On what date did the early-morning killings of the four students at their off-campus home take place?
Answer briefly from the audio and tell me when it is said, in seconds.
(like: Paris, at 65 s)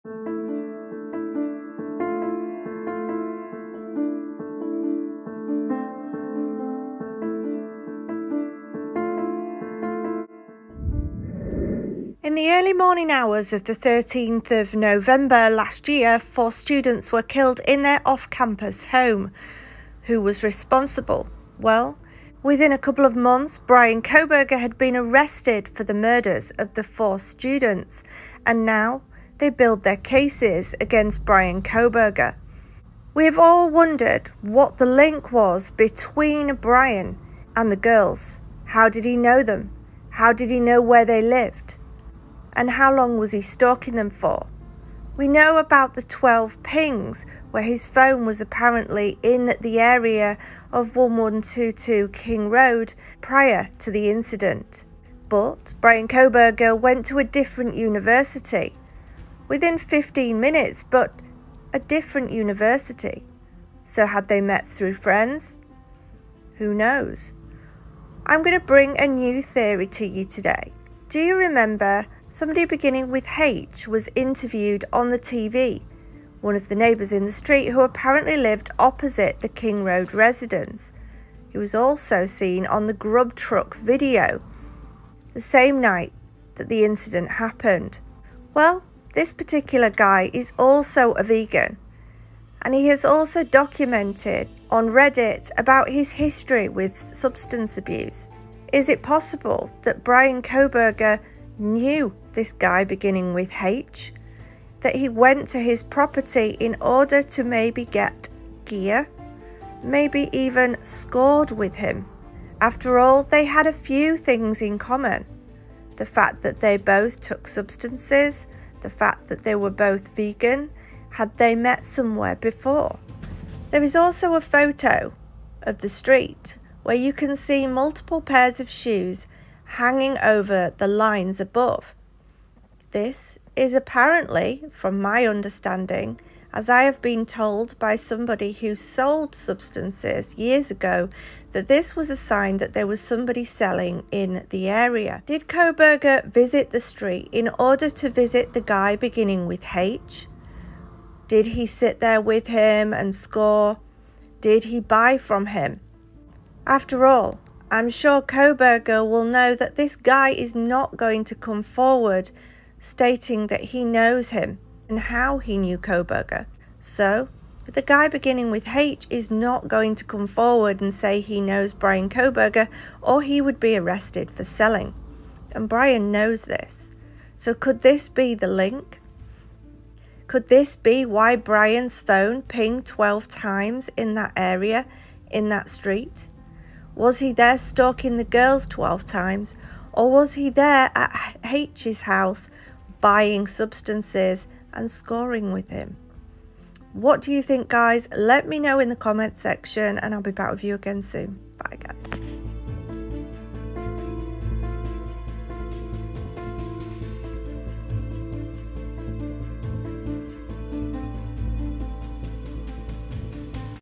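13 November, at 13 s.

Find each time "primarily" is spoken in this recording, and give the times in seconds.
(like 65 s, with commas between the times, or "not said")
not said.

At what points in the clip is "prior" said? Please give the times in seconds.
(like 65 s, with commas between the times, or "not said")
53 s.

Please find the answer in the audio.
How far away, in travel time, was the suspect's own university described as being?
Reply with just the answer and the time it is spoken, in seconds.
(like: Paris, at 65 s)
15 minutes, at 59 s.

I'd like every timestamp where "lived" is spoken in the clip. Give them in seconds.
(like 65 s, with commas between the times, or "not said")
41 s, 78 s.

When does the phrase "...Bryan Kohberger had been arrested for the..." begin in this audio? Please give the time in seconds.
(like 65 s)
23 s.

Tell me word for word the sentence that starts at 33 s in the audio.
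We have all wondered what the link was between Bryan and the girls.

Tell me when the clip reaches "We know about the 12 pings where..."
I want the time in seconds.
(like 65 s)
45 s.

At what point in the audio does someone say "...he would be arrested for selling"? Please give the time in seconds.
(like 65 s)
173 s.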